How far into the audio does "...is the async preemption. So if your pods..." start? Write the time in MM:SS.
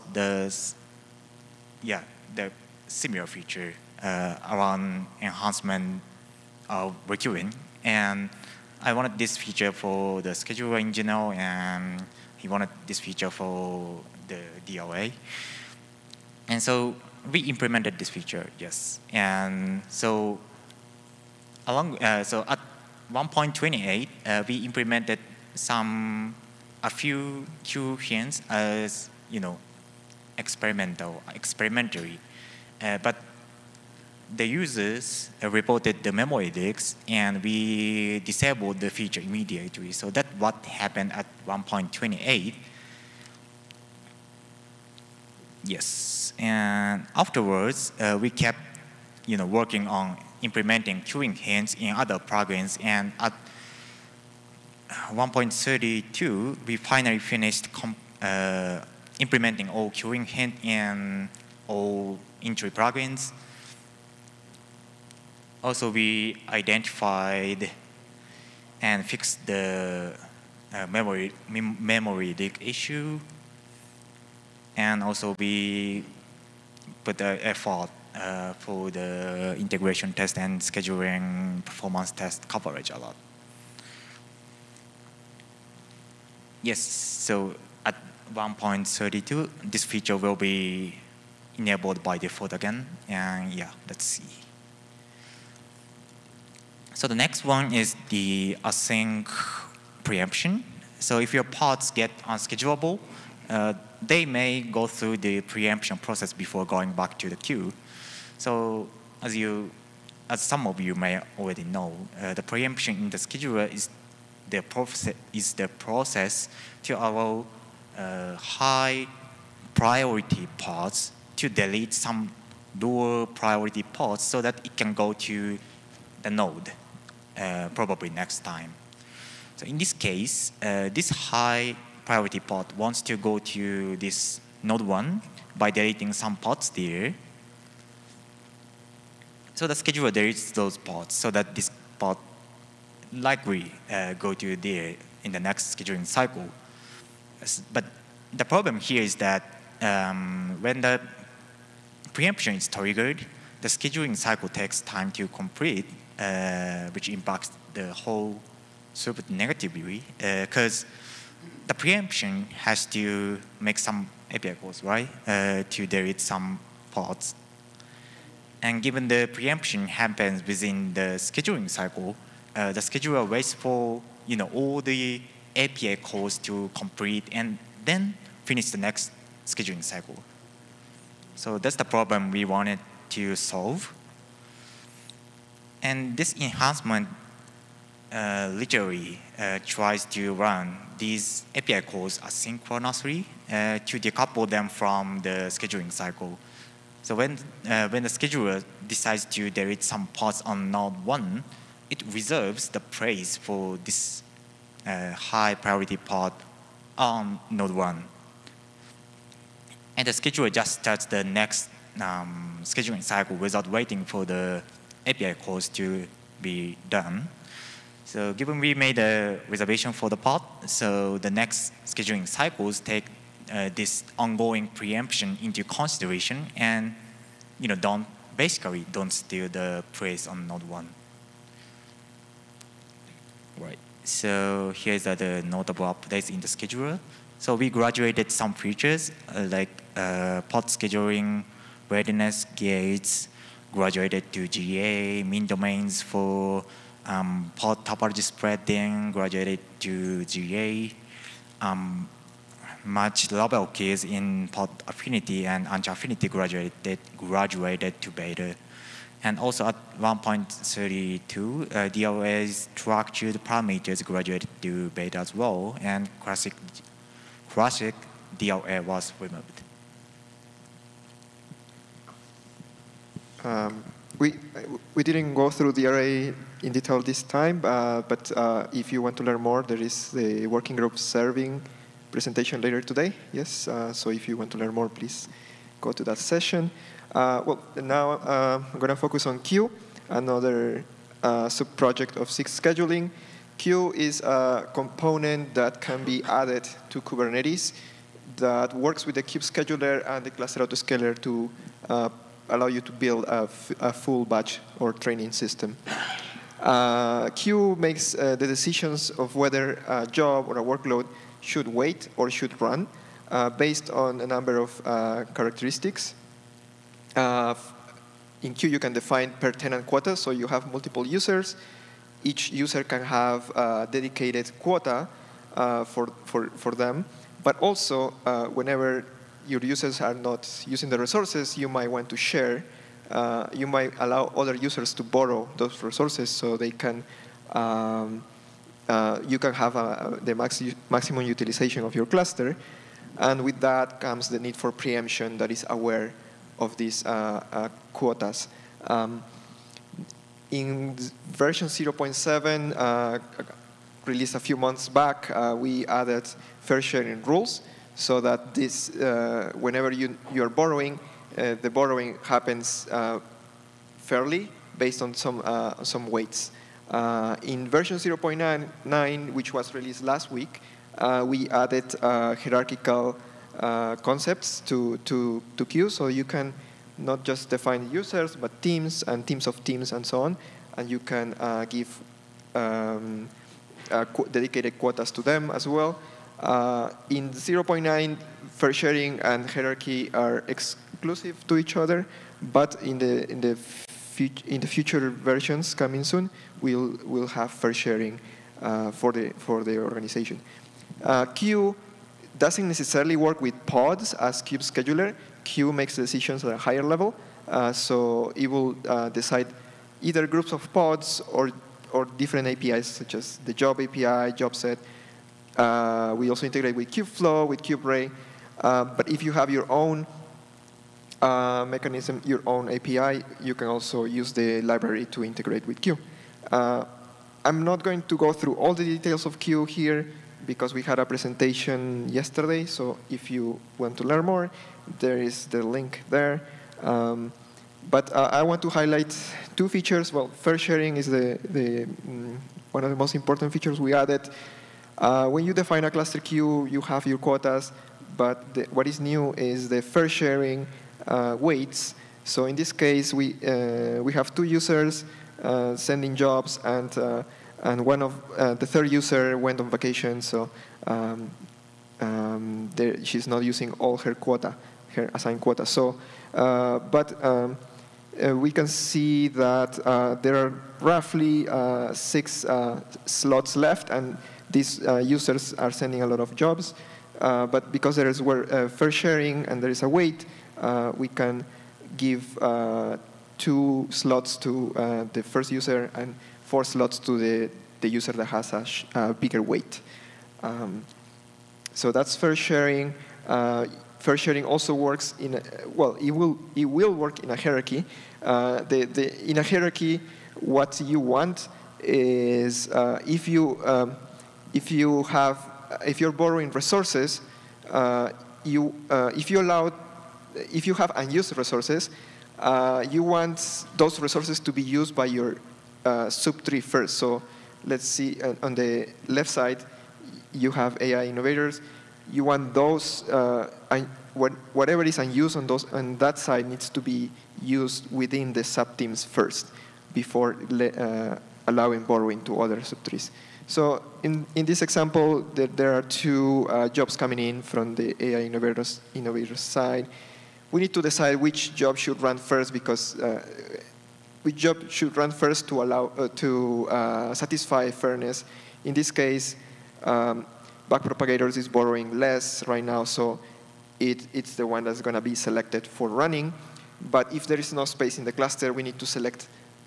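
01:37.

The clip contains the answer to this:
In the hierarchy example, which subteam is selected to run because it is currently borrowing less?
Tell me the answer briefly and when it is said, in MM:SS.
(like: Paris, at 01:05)
backpropagators, at 09:10.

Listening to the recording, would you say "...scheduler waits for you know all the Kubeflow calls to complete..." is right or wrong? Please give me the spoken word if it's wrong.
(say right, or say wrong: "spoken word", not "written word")
wrong: "API", not "Kubeflow".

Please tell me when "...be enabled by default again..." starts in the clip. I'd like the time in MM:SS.
01:30.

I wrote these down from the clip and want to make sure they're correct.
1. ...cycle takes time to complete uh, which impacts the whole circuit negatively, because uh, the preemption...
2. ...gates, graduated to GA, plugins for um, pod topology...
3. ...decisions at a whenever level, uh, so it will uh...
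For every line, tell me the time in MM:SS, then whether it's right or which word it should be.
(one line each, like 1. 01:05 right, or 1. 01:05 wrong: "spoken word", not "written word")
1. 02:34 right
2. 04:02 wrong: "minDomains", not "plugins"
3. 06:45 wrong: "higher", not "whenever".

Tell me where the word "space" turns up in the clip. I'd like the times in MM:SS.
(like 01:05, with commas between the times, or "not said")
09:17.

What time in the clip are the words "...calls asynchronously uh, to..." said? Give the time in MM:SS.
03:11.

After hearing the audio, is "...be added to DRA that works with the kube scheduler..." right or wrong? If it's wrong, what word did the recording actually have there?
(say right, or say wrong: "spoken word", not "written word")
wrong: "Kubernetes", not "DRA".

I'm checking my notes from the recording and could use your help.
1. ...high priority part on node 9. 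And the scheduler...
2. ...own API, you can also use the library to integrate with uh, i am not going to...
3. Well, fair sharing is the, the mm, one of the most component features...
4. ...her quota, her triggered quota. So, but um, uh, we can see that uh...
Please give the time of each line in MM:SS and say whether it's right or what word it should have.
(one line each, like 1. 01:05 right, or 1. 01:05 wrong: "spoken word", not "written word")
1. 03:25 wrong: "1", not "9"
2. 07:02 right
3. 07:20 wrong: "important", not "component"
4. 07:43 wrong: "assigned", not "triggered".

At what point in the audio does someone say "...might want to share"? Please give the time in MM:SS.
05:31.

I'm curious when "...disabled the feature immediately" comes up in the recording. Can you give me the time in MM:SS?
00:38.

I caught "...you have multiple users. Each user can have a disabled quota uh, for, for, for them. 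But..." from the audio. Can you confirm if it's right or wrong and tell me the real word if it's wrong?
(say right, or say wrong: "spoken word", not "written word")
wrong: "dedicated", not "disabled".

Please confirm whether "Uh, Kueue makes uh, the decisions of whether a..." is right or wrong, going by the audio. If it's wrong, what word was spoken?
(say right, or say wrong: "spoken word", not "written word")
right.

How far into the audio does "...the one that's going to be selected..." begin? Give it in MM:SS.
09:14.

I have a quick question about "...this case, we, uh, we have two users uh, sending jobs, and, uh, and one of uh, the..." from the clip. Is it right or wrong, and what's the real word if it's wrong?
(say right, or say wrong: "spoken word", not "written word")
right.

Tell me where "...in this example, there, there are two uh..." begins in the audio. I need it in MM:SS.
08:54.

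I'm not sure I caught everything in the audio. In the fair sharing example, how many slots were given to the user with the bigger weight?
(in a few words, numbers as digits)
4.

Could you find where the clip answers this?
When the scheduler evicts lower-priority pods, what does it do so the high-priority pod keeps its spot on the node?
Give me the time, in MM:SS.
03:22.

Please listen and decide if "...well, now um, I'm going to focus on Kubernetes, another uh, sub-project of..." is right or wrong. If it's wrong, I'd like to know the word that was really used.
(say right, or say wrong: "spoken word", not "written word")
wrong: "Kueue", not "Kubernetes".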